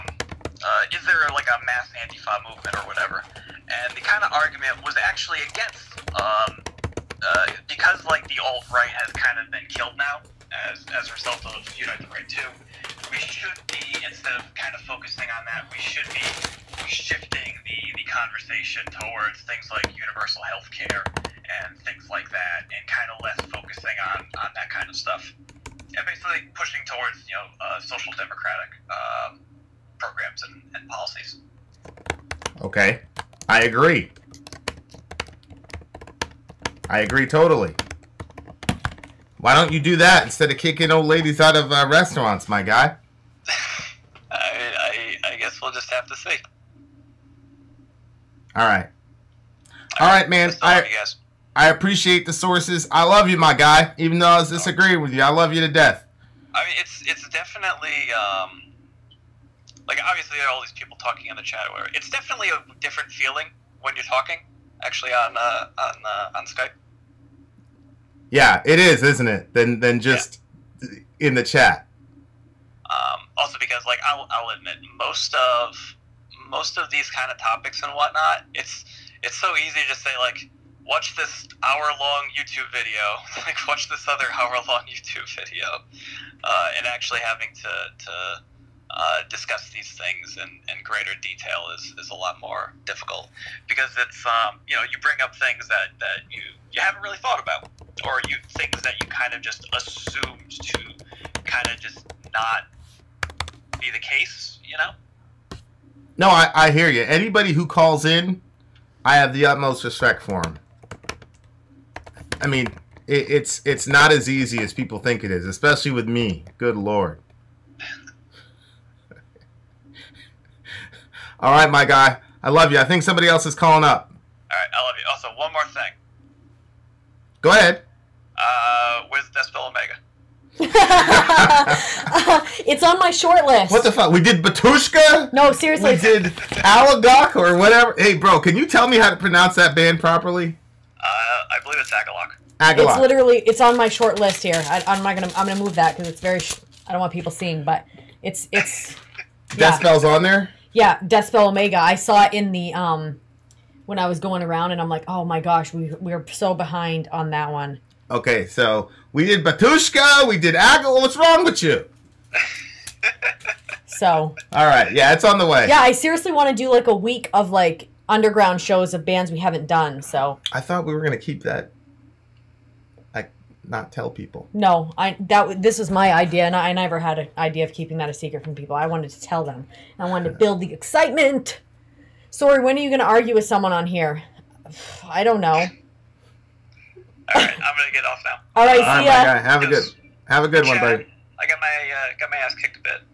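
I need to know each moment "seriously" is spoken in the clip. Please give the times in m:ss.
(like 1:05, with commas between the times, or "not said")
2:15, 2:45.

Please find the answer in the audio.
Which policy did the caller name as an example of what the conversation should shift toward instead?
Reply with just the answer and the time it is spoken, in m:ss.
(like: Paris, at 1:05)
Universal health care, at 0:19.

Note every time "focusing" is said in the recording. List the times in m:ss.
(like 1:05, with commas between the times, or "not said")
0:14, 0:23.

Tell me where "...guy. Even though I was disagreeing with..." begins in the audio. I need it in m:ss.
0:53.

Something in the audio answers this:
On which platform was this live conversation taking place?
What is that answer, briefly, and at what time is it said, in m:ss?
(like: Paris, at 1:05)
Skype, at 1:06.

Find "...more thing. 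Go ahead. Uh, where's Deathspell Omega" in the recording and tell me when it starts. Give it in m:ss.
2:05.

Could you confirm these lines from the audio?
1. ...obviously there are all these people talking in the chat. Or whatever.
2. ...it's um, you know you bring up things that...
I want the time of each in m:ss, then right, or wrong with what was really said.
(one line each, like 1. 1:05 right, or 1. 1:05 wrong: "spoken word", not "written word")
1. 1:00 right
2. 1:34 right.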